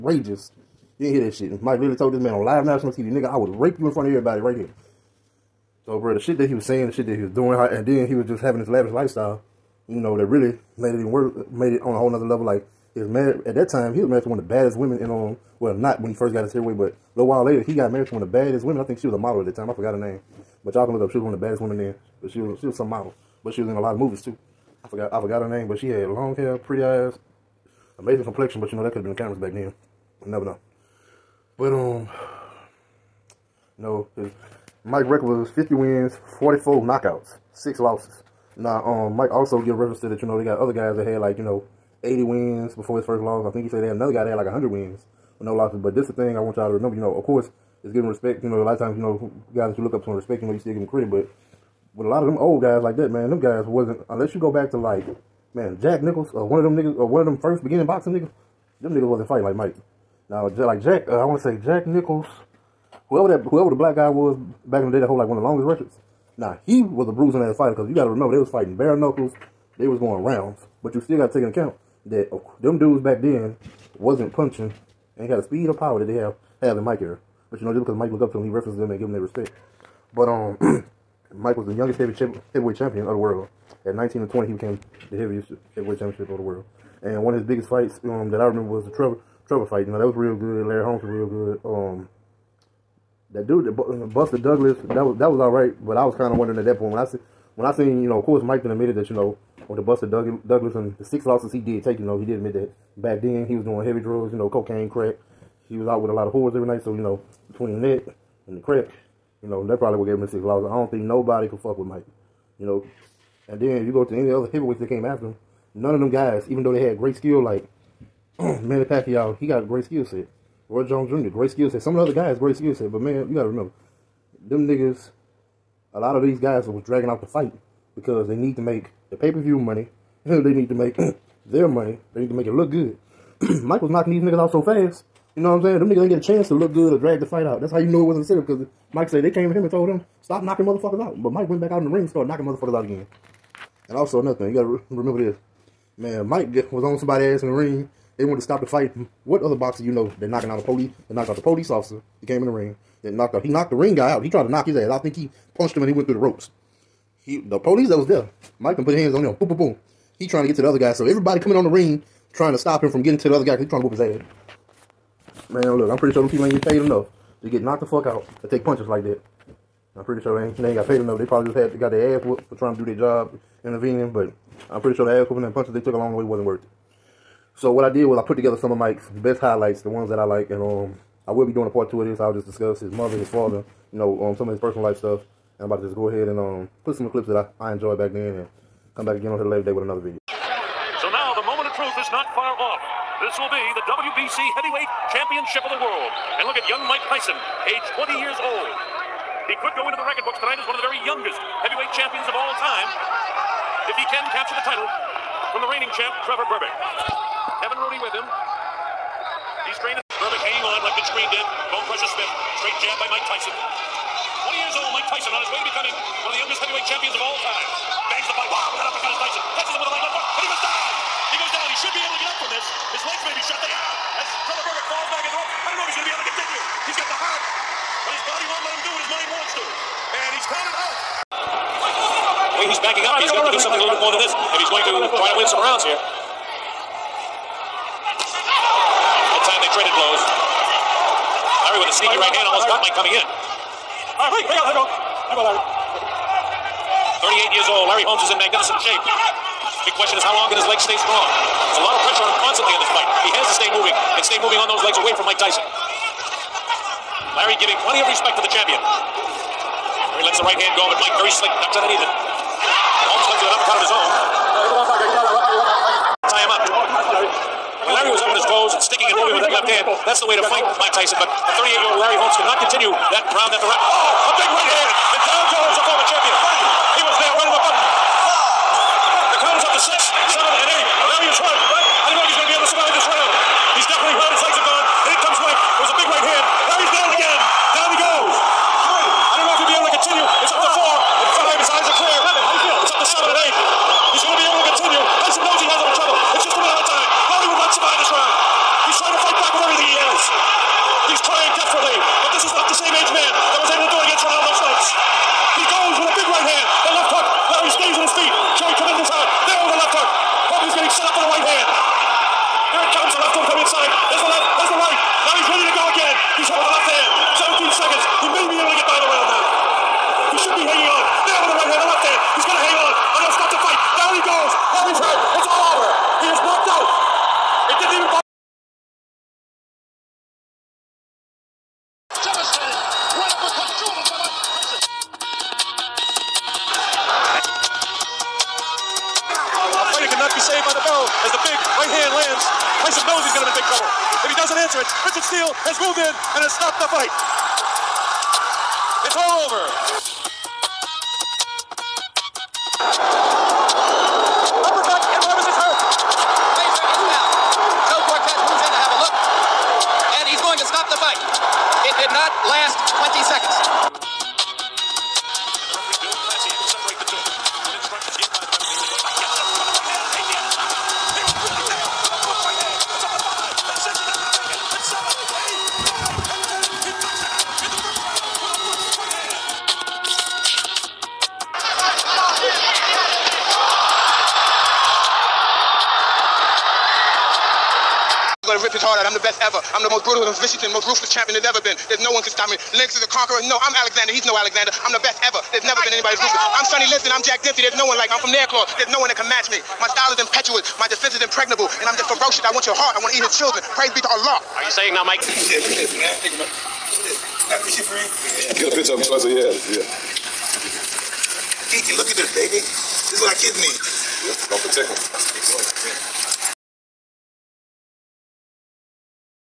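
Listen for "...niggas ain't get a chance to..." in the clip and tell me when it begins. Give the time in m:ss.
2:15.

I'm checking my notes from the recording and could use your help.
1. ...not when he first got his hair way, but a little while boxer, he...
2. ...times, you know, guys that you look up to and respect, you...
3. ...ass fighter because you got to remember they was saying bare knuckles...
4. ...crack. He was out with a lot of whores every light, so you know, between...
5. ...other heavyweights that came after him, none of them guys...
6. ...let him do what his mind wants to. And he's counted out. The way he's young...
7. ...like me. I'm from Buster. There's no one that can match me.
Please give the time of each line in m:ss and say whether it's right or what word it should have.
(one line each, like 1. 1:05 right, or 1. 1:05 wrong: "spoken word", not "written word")
1. 0:15 wrong: "later", not "boxer"
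2. 0:48 right
3. 1:07 wrong: "fighting", not "saying"
4. 1:44 wrong: "night", not "light"
5. 1:54 right
6. 3:48 wrong: "backing", not "young"
7. 6:37 wrong: "Nairclaw", not "Buster".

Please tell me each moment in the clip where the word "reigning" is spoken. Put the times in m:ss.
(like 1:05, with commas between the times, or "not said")
3:25.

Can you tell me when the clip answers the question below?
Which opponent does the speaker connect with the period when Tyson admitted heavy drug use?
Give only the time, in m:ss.
1:34.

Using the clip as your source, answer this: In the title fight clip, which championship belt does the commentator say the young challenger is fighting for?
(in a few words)
WBC Heavyweight Championship.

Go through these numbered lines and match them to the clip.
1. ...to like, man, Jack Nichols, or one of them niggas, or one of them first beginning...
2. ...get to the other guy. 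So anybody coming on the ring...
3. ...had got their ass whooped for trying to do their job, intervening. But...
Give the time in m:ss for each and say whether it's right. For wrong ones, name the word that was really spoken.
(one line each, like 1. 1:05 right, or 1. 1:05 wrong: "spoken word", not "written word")
1. 0:54 right
2. 2:40 wrong: "everybody", not "anybody"
3. 2:51 right.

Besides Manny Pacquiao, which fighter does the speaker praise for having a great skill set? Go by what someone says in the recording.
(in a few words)
Roy Jones Jr.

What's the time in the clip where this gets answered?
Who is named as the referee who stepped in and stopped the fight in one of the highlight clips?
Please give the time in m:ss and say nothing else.
5:45.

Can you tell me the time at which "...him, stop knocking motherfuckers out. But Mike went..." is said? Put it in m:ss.
2:19.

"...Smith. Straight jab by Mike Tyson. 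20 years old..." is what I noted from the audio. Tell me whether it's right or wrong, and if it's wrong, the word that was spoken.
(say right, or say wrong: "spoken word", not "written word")
right.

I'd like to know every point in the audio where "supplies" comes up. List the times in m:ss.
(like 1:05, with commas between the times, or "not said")
not said.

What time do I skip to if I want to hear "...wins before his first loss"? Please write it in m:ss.
0:42.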